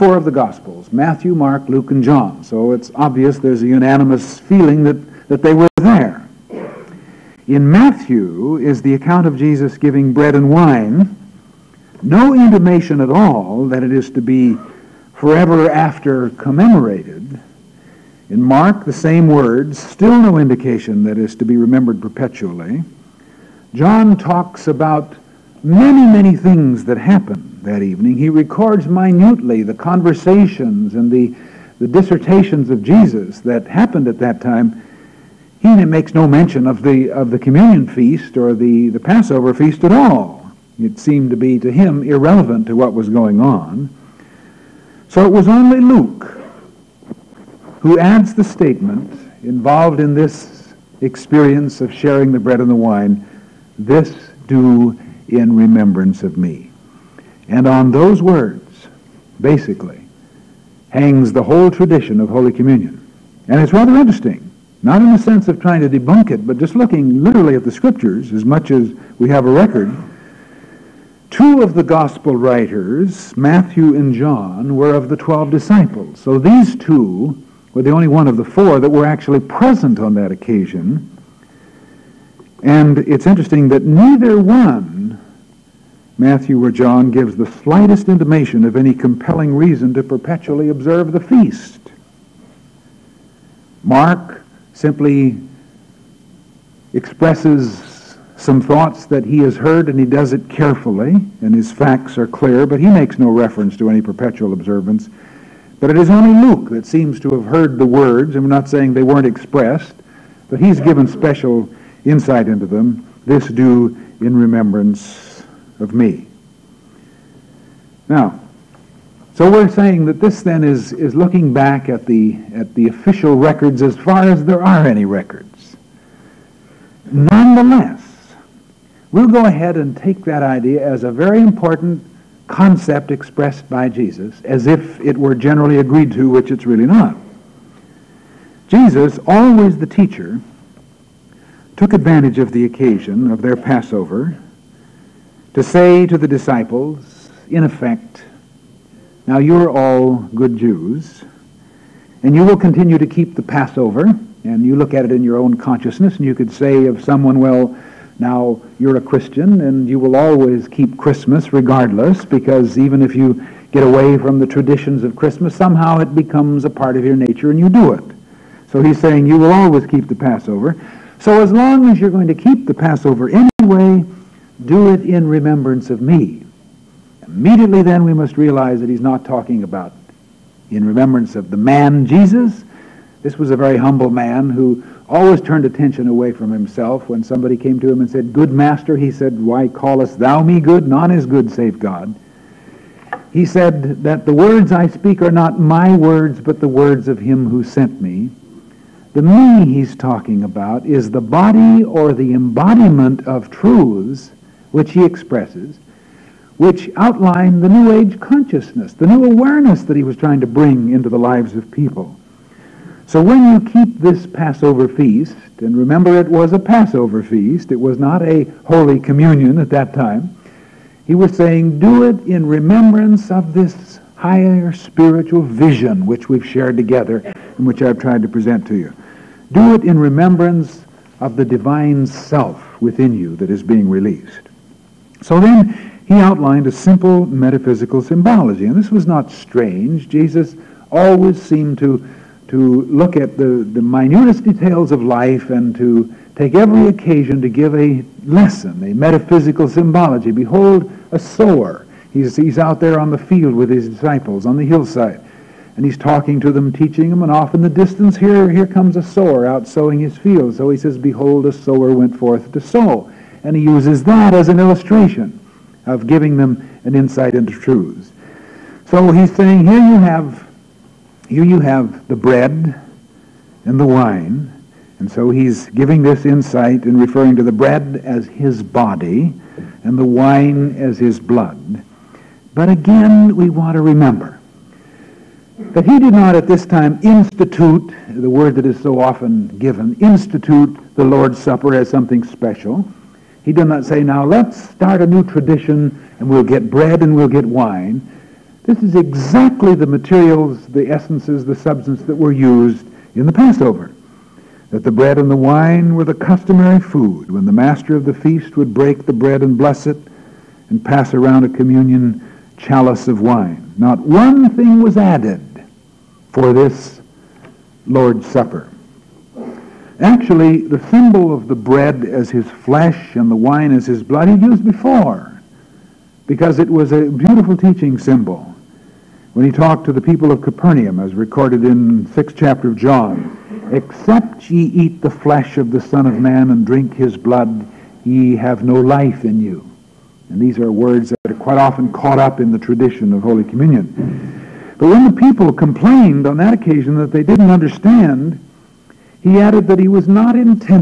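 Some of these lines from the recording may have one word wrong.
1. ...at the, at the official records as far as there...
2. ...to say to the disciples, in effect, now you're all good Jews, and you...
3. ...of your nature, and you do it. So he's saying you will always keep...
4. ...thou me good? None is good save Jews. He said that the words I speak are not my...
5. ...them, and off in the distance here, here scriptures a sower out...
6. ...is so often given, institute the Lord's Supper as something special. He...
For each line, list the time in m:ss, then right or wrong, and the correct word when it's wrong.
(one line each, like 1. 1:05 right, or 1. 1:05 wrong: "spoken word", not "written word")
1. 2:01 right
2. 2:25 right
3. 2:46 right
4. 3:10 wrong: "God", not "Jews"
5. 4:17 wrong: "comes", not "scriptures"
6. 4:48 right.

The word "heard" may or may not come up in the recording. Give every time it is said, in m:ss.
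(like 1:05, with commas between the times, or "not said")
1:39, 1:47.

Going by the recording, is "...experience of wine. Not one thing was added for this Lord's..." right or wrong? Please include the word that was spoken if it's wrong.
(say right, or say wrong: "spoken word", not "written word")
wrong: "chalice", not "experience".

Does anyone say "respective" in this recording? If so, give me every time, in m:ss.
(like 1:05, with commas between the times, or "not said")
not said.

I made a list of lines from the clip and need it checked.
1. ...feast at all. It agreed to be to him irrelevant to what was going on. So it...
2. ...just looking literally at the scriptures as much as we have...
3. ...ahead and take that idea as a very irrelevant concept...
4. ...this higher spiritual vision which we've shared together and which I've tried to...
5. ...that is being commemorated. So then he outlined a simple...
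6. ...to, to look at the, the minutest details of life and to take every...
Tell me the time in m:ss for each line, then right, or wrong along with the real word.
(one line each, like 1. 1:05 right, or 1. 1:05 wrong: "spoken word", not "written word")
1. 0:39 wrong: "seemed", not "agreed"
2. 1:06 right
3. 2:09 wrong: "important", not "irrelevant"
4. 3:43 right
5. 3:53 wrong: "released", not "commemorated"
6. 4:01 right.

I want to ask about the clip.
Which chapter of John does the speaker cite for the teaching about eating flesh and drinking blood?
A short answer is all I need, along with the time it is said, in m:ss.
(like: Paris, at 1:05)
6th chapter, at 5:32.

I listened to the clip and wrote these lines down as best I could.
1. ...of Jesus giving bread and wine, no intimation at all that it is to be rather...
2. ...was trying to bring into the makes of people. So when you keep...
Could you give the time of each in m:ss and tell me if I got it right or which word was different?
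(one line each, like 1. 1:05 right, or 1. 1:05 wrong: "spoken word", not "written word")
1. 0:09 wrong: "forever", not "rather"
2. 3:30 wrong: "lives", not "makes".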